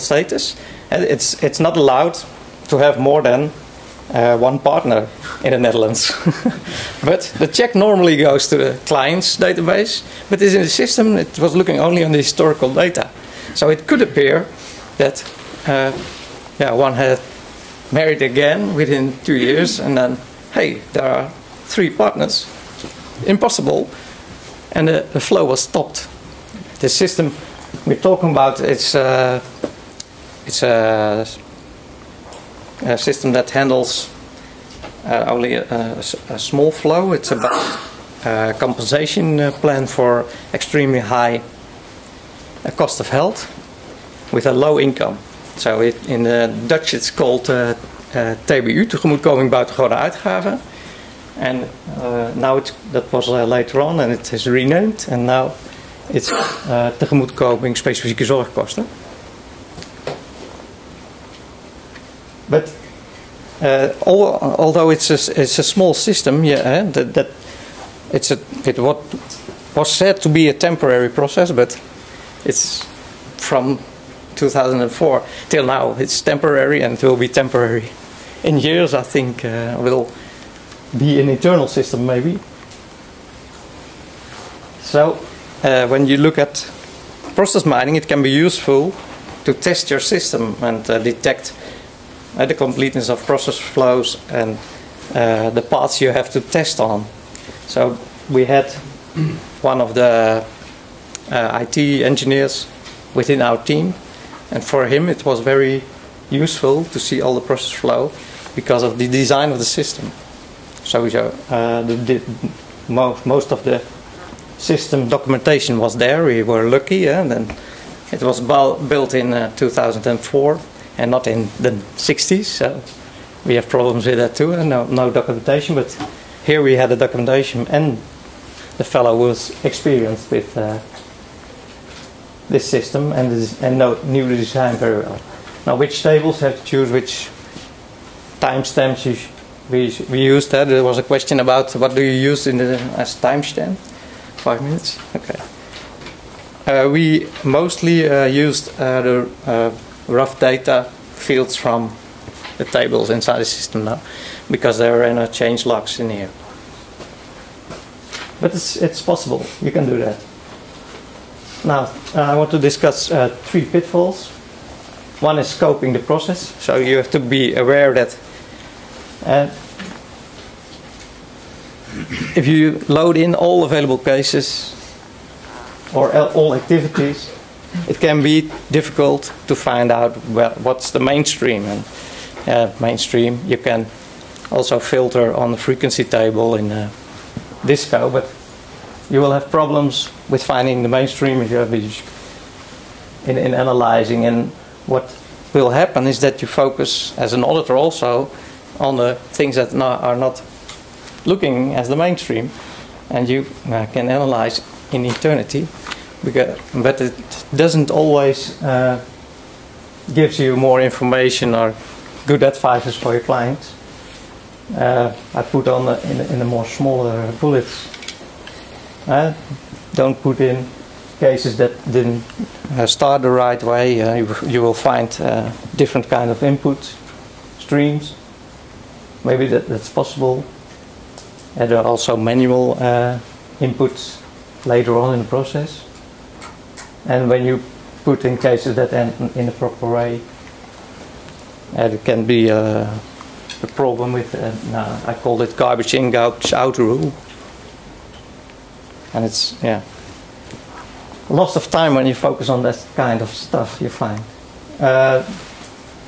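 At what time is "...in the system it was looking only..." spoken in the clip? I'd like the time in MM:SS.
00:10.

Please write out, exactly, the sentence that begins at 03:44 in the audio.
Uh, you, you, will find uh, different kind of input streams.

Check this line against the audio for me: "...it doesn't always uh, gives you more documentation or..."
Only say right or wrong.
wrong.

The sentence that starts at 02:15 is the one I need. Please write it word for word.
Now which tables have to choose which timestamps we, we used that.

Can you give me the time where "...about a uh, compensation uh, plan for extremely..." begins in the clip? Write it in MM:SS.
00:37.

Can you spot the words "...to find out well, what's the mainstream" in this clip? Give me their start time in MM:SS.
02:59.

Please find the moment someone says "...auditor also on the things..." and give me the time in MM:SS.
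03:17.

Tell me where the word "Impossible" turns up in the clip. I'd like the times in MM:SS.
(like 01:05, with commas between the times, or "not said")
00:23.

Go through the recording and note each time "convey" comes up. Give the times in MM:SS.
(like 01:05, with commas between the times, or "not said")
not said.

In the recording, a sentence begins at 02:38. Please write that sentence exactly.
But it's, it's possible, you can do that.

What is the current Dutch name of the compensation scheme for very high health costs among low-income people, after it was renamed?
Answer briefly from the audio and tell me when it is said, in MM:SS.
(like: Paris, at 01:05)
tegemoetkoming specifieke zorgkosten, at 00:56.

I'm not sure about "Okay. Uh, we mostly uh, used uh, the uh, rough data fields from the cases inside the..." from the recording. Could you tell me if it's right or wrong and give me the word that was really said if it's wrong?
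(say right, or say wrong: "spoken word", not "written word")
wrong: "tables", not "cases".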